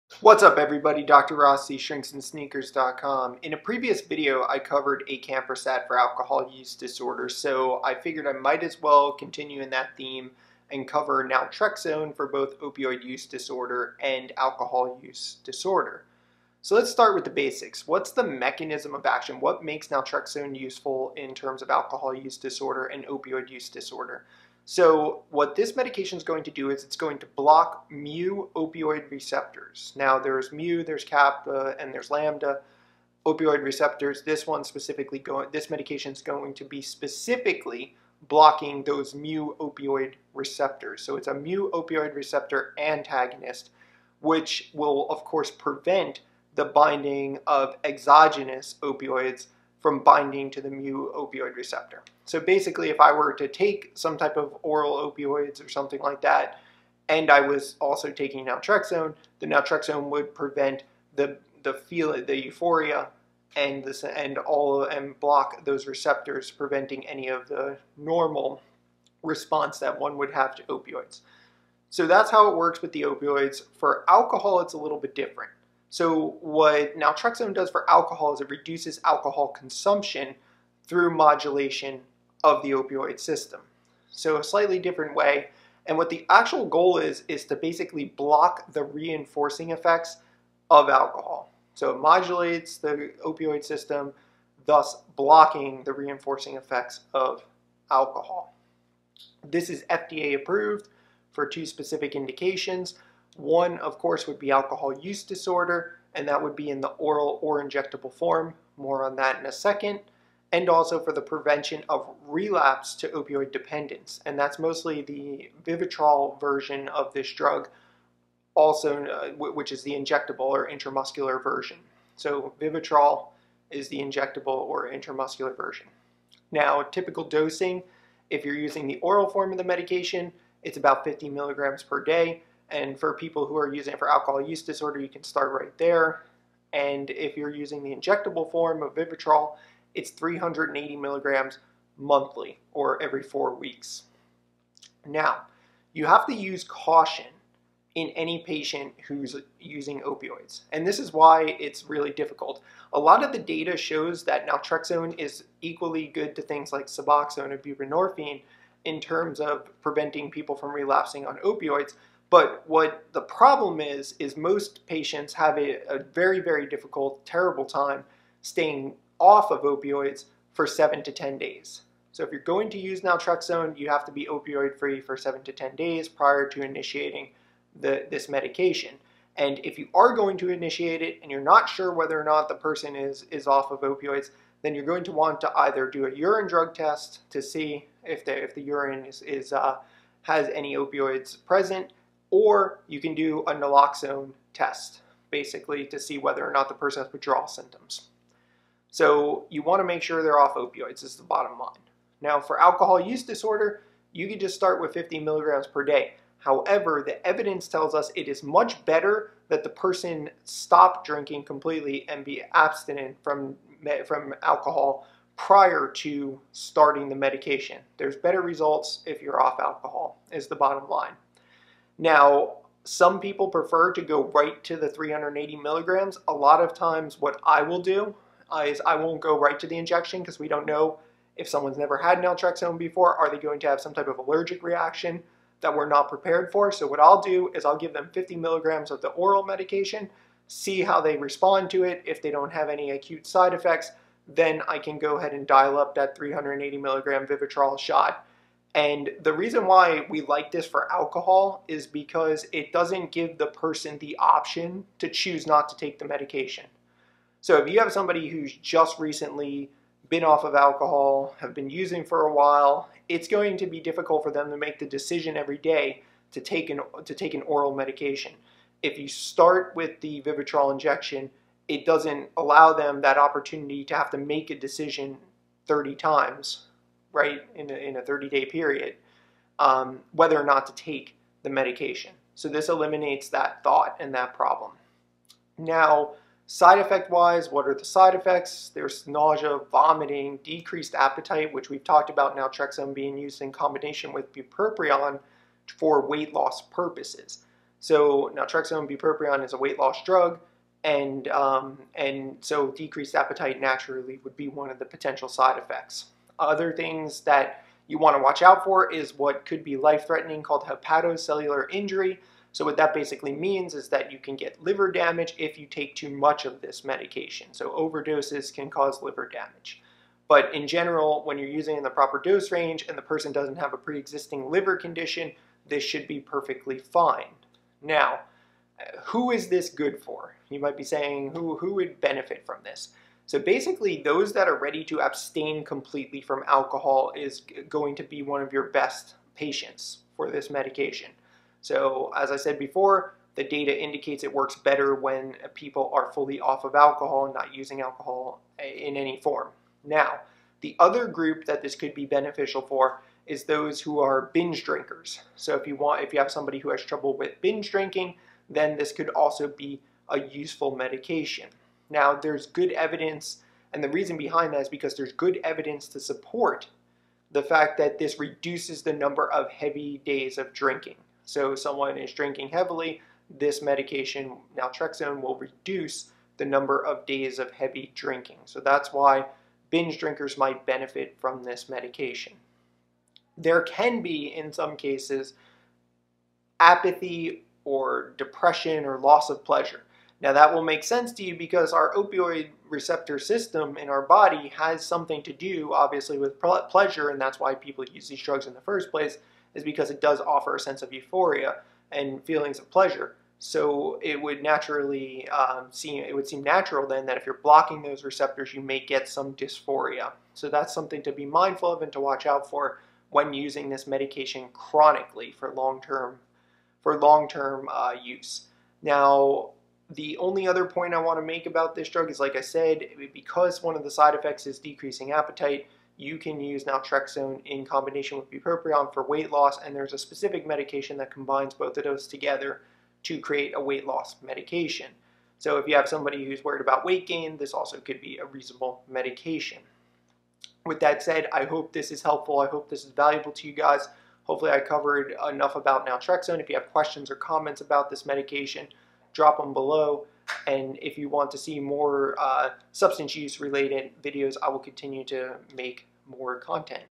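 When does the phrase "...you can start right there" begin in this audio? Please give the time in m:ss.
2:14.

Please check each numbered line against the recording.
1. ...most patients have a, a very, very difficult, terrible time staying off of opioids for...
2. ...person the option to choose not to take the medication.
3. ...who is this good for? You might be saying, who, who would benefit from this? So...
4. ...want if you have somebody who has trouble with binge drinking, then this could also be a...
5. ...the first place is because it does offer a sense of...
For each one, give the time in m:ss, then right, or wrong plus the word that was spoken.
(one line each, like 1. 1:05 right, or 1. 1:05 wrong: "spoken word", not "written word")
1. 2:44 right
2. 4:13 right
3. 5:29 right
4. 5:55 right
5. 6:38 right.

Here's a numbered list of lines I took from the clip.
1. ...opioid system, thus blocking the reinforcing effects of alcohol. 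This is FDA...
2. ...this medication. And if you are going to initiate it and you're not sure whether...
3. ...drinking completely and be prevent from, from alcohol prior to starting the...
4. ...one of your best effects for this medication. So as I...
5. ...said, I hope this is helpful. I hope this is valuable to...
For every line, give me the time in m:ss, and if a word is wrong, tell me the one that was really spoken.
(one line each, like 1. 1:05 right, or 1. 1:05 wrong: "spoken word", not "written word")
1. 1:33 right
2. 2:58 right
3. 3:31 wrong: "abstinent", not "prevent"
4. 5:38 wrong: "patients", not "effects"
5. 7:21 right.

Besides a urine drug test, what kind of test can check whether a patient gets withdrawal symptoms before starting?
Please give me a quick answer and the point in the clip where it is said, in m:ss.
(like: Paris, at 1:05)
naloxone test, at 3:13.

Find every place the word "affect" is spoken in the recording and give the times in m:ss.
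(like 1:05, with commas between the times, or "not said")
not said.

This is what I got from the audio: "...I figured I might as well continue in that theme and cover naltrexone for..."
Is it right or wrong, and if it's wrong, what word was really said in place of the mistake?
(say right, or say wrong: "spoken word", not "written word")
right.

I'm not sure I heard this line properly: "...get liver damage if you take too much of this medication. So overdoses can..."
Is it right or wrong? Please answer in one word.
right.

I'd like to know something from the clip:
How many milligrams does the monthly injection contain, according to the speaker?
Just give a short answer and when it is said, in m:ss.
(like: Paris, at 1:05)
380 milligrams, at 2:20.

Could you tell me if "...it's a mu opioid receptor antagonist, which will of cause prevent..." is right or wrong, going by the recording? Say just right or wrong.
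wrong.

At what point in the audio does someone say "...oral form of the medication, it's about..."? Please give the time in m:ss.
2:08.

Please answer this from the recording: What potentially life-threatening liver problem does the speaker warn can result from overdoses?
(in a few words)
hepatocellular injury.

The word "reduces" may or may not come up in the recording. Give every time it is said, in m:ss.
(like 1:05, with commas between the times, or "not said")
1:18, 6:08, 6:15.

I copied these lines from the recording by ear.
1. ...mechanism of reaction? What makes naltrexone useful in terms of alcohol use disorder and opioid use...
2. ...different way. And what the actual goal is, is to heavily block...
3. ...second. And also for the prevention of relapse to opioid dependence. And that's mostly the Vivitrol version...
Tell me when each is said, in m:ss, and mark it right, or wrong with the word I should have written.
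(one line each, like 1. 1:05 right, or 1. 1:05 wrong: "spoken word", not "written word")
1. 0:18 wrong: "action", not "reaction"
2. 1:24 wrong: "basically", not "heavily"
3. 1:49 right.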